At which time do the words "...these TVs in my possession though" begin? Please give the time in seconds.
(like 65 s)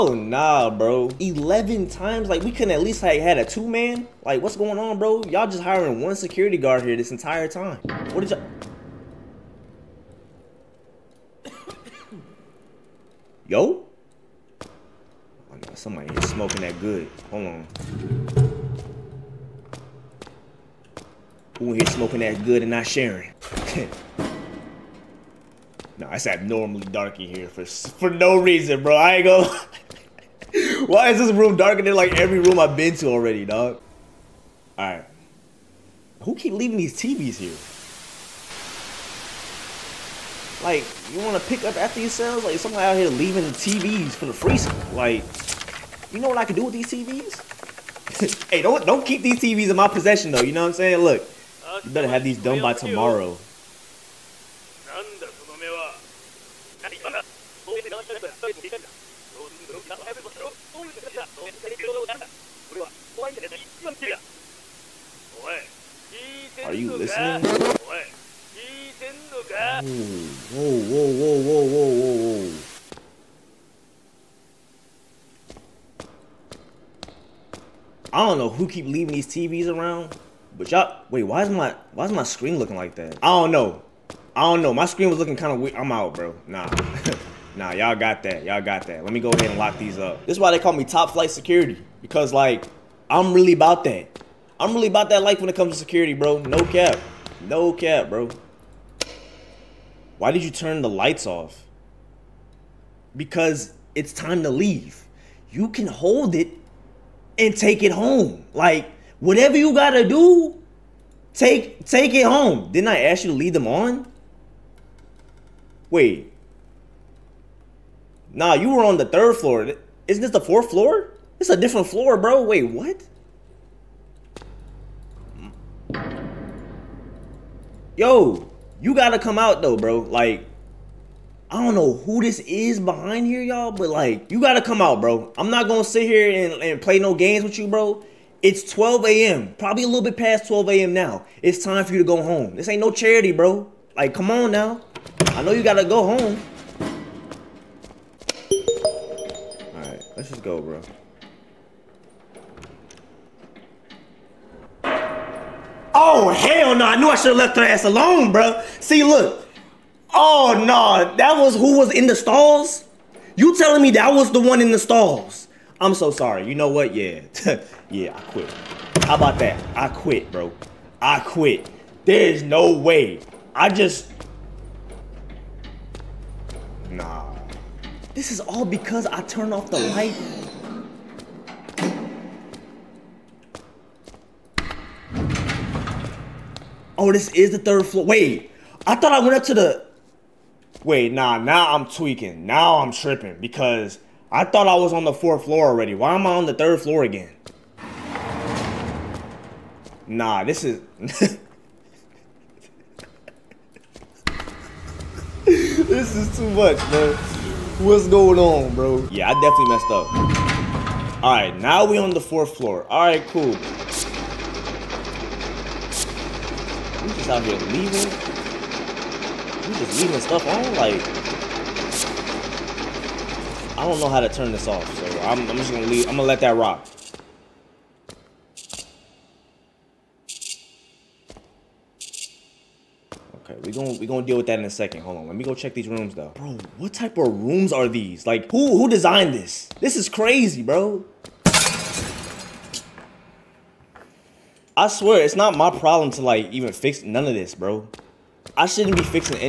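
49 s.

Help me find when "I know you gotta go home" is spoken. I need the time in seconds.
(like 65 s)
145 s.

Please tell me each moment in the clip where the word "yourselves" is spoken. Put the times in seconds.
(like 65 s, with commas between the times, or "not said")
42 s.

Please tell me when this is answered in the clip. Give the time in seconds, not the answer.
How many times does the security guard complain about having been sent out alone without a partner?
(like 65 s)
1 s.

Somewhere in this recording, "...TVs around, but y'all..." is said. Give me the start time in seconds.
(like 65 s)
79 s.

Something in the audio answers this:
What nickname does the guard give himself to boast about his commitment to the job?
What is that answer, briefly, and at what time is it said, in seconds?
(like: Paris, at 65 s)
top flight security, at 90 s.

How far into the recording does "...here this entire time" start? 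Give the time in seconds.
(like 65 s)
6 s.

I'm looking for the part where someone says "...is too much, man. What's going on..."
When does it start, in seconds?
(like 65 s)
206 s.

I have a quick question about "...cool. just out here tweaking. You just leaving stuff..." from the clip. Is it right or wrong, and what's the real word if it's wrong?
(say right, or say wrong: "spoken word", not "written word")
wrong: "leaving", not "tweaking".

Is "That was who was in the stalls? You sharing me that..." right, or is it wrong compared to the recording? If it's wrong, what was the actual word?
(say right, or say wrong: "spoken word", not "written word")
wrong: "telling", not "sharing".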